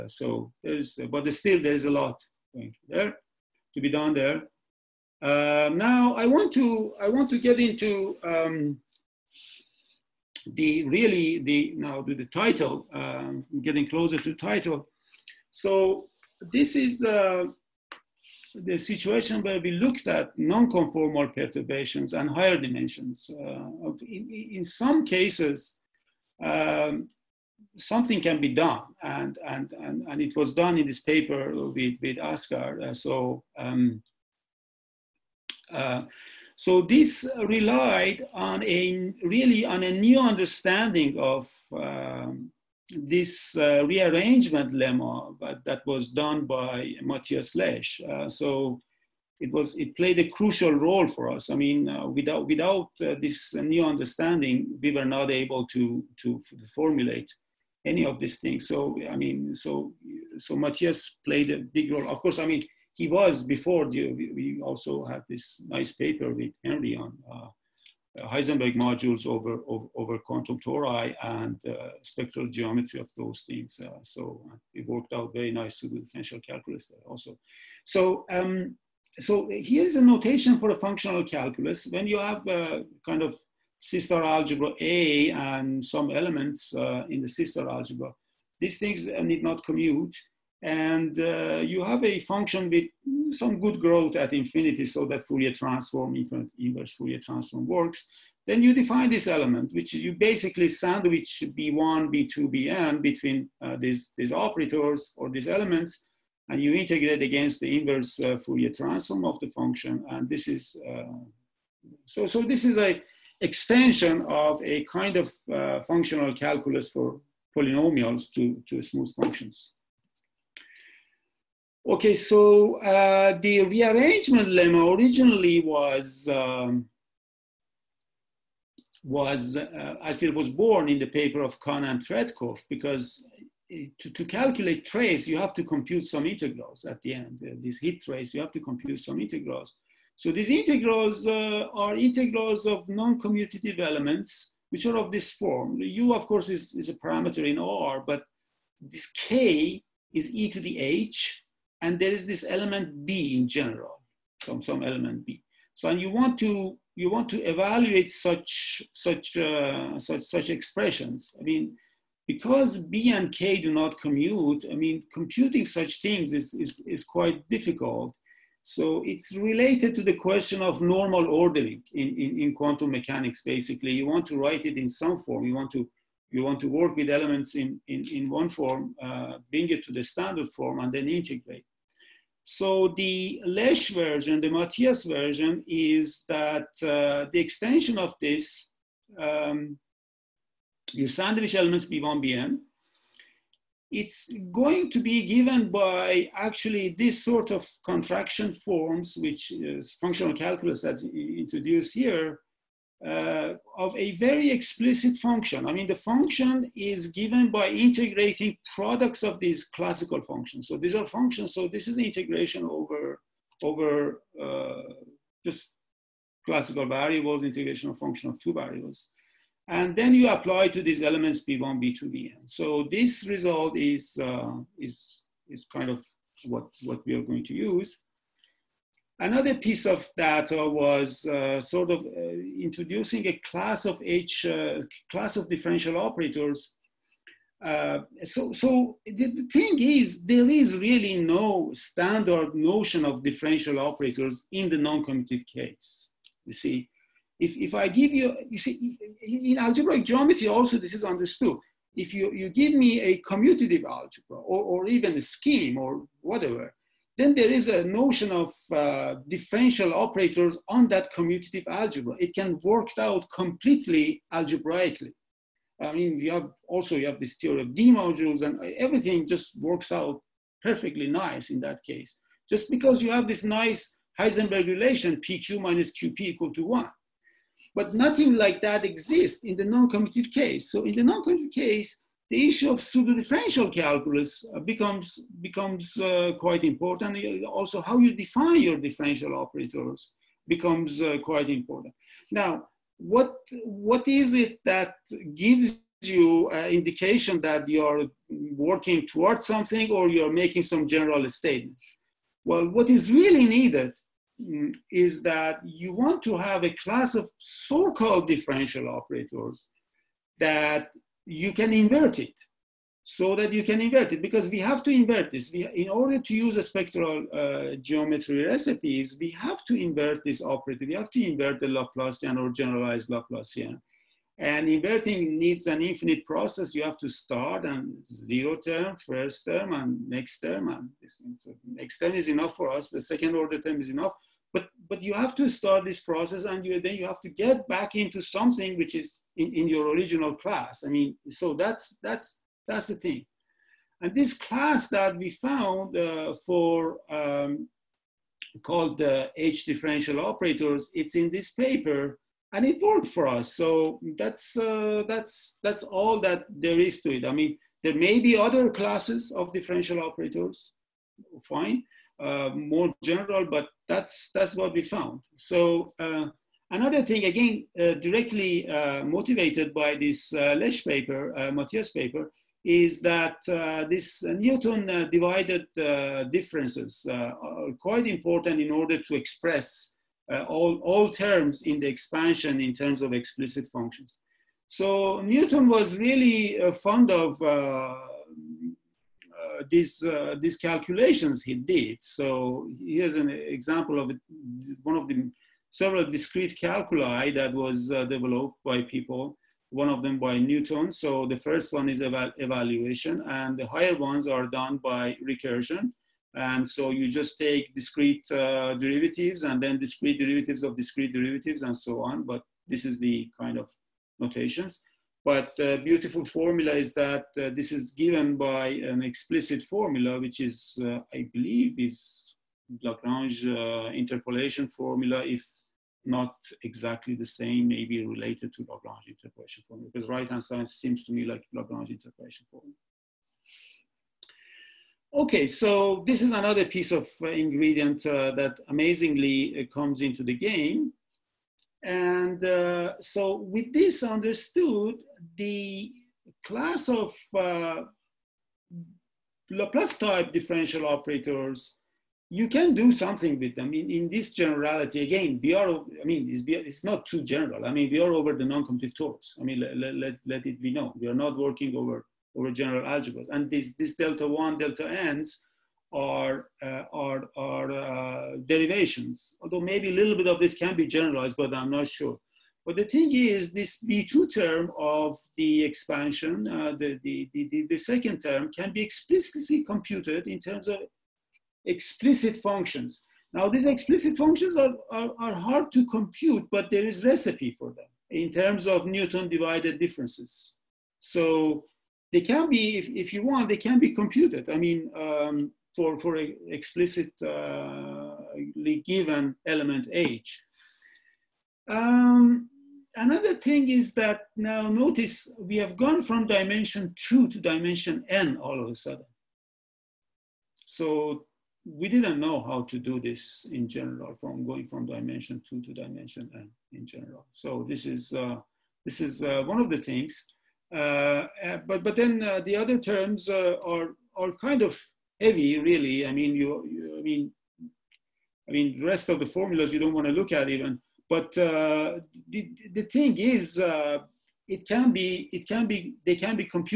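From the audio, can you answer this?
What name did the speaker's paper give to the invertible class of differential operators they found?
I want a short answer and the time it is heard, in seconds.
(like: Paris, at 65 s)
H differential operators, at 349 s.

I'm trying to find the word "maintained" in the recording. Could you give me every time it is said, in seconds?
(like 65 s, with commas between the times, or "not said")
not said.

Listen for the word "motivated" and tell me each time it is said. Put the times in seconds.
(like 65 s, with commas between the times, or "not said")
369 s.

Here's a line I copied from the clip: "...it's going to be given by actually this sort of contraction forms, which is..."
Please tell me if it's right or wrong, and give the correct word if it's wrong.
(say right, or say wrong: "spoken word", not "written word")
right.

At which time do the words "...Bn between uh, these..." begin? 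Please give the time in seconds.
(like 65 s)
102 s.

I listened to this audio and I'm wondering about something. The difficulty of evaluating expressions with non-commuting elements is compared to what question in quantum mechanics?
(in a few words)
normal ordering.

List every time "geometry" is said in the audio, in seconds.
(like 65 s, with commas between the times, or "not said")
72 s, 250 s, 317 s.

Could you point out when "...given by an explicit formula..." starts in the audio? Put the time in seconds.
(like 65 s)
417 s.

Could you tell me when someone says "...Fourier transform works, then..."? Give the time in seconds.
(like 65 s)
96 s.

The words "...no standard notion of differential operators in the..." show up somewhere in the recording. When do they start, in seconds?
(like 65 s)
241 s.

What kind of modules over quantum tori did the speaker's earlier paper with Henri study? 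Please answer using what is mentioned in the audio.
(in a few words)
Heisenberg modules.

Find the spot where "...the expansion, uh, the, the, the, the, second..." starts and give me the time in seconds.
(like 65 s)
475 s.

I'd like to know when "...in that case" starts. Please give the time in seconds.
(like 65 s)
271 s.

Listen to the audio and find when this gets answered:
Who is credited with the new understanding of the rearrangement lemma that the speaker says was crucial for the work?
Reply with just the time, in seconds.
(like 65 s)
47 s.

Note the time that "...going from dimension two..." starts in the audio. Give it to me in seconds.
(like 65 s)
514 s.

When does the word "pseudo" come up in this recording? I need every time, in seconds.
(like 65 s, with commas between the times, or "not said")
282 s.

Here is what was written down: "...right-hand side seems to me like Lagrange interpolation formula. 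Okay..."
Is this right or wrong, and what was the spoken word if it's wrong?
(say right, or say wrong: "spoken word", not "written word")
right.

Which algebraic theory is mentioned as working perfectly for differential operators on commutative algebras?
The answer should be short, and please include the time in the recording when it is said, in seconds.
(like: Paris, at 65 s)
D modules, at 267 s.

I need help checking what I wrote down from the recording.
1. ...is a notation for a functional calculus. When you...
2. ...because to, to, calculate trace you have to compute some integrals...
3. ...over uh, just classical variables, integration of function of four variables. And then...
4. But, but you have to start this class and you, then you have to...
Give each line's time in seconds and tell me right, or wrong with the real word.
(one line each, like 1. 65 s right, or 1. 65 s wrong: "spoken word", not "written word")
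1. 79 s right
2. 132 s right
3. 213 s wrong: "two", not "four"
4. 334 s wrong: "process", not "class".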